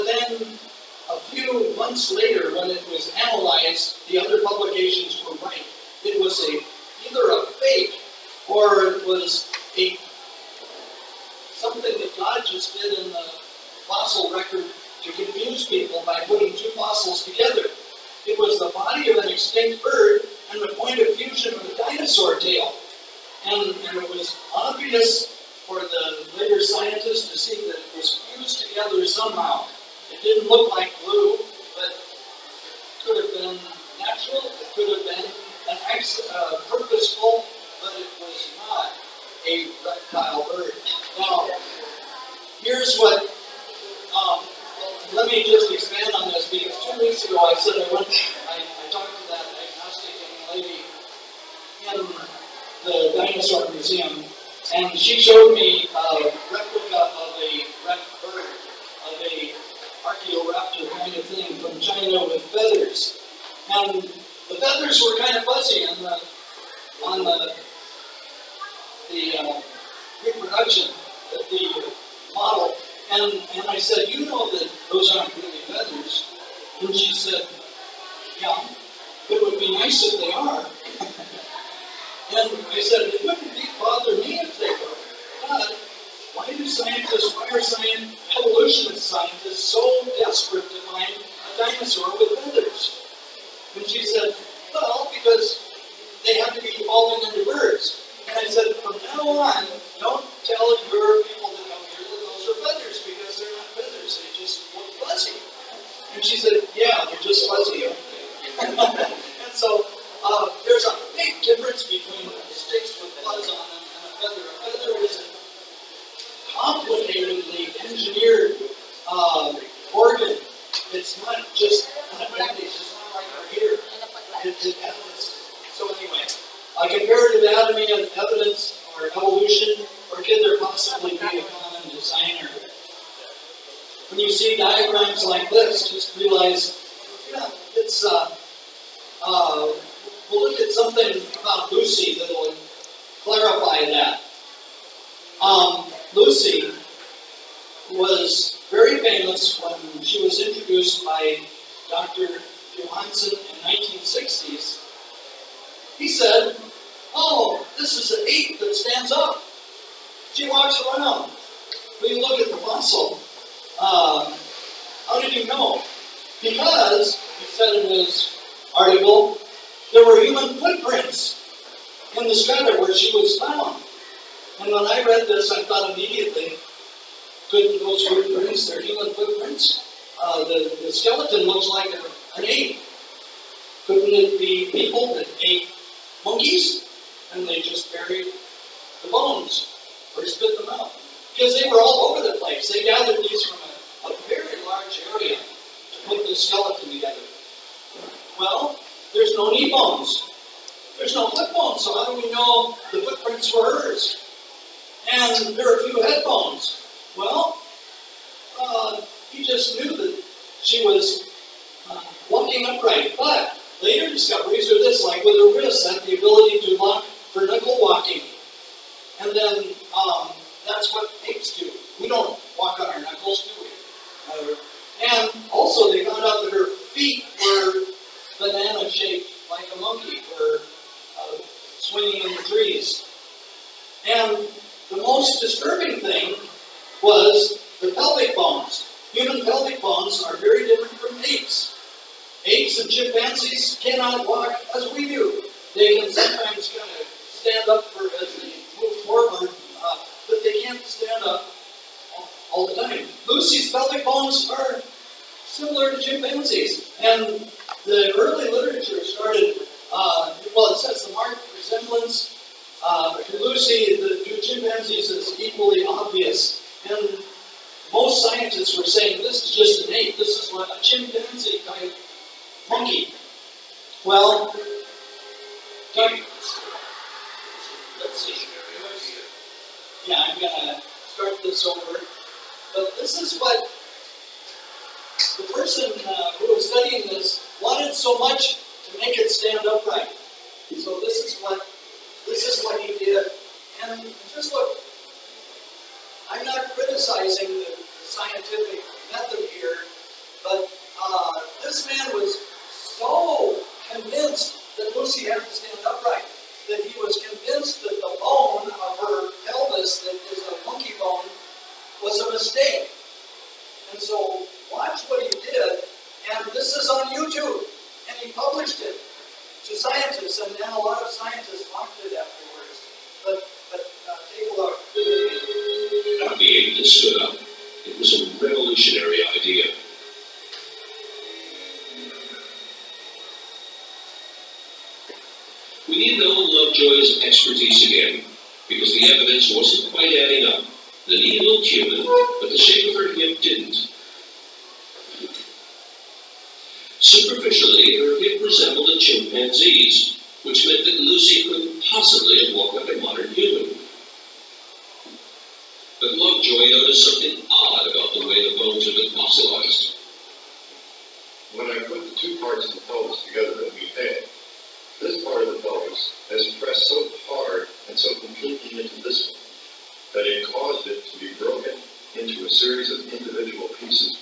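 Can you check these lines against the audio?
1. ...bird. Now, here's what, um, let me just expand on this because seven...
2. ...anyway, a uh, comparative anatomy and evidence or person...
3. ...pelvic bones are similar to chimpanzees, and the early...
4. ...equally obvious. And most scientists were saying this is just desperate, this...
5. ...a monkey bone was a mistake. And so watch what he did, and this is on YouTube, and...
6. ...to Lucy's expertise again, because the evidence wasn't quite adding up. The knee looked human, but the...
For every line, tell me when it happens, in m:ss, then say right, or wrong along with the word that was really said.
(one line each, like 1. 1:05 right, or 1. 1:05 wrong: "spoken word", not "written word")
1. 0:40 wrong: "two", not "seven"
2. 2:05 wrong: "evolution", not "person"
3. 4:13 right
4. 4:25 wrong: "innate", not "desperate"
5. 5:10 right
6. 5:36 wrong: "Lovejoy", not "Lucy".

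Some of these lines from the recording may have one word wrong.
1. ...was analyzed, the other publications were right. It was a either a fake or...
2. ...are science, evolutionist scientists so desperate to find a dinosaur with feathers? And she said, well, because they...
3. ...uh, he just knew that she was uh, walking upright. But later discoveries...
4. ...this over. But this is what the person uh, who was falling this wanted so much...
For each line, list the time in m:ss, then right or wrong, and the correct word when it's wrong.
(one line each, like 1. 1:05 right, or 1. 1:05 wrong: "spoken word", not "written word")
1. 0:02 right
2. 1:27 right
3. 3:28 right
4. 4:41 wrong: "studying", not "falling".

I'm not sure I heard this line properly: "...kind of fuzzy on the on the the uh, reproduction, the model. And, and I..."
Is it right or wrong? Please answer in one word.
right.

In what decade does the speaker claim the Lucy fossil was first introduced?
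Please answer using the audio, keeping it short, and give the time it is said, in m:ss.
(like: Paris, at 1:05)
1960s, at 2:33.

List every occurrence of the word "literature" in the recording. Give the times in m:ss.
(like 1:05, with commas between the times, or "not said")
4:18.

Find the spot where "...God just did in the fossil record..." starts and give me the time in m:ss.
0:12.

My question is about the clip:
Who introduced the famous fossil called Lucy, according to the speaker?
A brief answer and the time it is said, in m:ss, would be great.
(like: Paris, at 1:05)
Dr. Johanson, at 2:31.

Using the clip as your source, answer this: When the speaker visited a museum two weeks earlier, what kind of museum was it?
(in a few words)
dinosaur museum.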